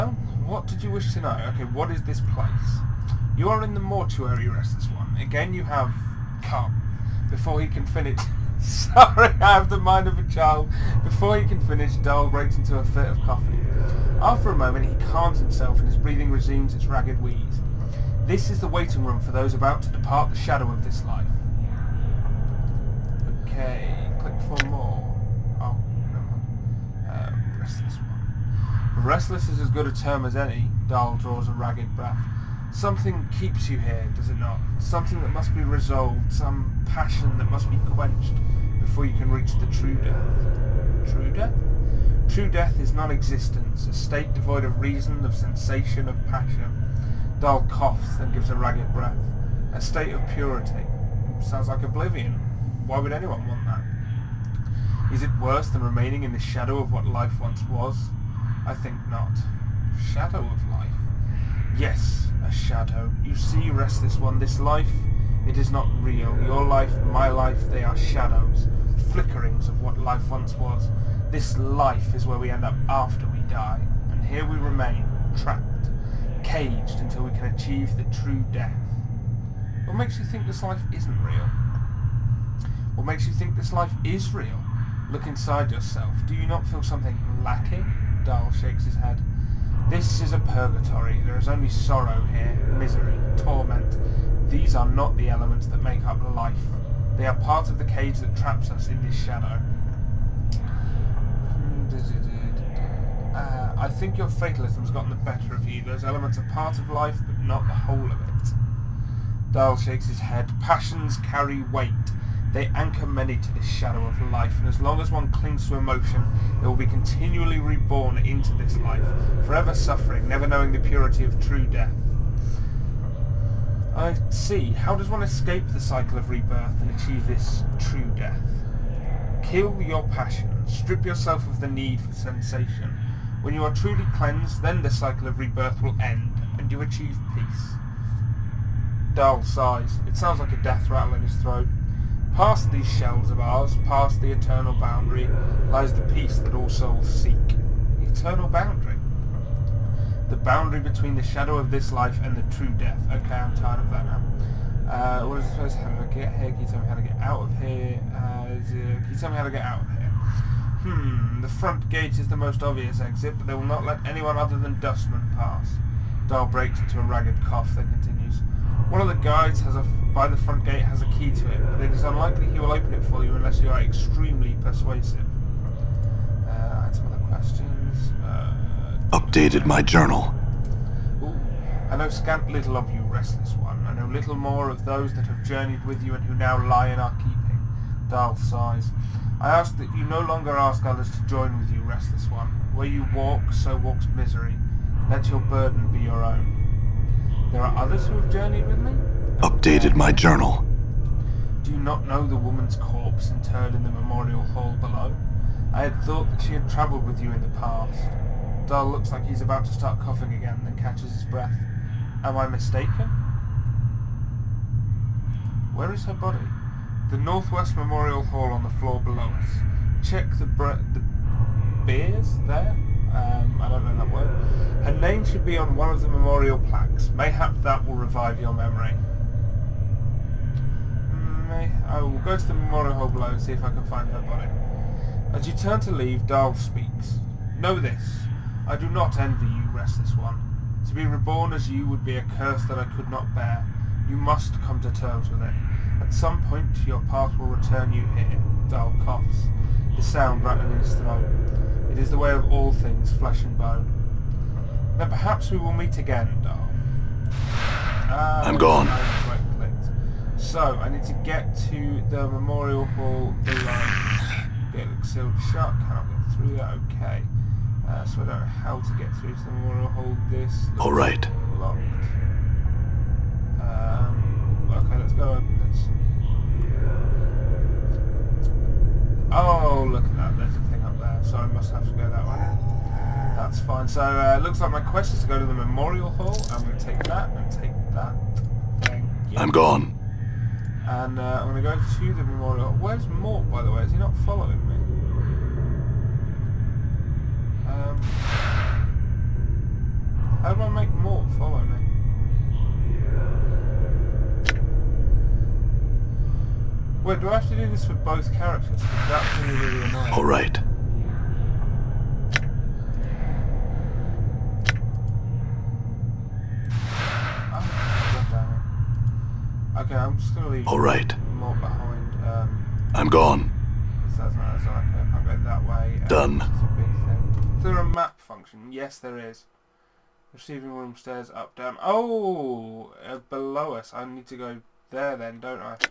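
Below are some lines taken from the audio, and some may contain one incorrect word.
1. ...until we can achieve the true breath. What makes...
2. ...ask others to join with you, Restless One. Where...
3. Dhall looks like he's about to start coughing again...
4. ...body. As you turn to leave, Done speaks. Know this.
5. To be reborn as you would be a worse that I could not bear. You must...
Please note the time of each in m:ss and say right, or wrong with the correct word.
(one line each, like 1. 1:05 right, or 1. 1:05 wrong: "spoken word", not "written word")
1. 1:16 wrong: "death", not "breath"
2. 3:10 right
3. 3:28 right
4. 3:54 wrong: "Dhall", not "Done"
5. 4:00 wrong: "curse", not "worse".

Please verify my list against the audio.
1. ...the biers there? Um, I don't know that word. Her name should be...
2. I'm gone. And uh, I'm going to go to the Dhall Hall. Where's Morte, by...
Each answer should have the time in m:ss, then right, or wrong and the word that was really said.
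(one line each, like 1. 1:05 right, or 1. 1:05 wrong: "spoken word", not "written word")
1. 3:40 right
2. 4:49 wrong: "Memorial", not "Dhall".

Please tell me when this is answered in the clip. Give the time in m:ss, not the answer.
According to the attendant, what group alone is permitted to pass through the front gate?
2:44.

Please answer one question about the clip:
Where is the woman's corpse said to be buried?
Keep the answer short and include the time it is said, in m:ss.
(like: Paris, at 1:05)
Northwest Memorial Hall, at 3:37.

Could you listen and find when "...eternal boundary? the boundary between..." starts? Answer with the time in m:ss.
2:28.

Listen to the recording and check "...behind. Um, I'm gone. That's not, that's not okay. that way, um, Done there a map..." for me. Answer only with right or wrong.
right.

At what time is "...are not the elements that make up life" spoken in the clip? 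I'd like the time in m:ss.
1:34.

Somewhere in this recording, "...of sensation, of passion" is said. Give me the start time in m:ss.
0:45.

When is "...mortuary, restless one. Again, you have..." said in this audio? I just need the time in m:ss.
0:03.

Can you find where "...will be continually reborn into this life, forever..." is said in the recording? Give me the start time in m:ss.
1:56.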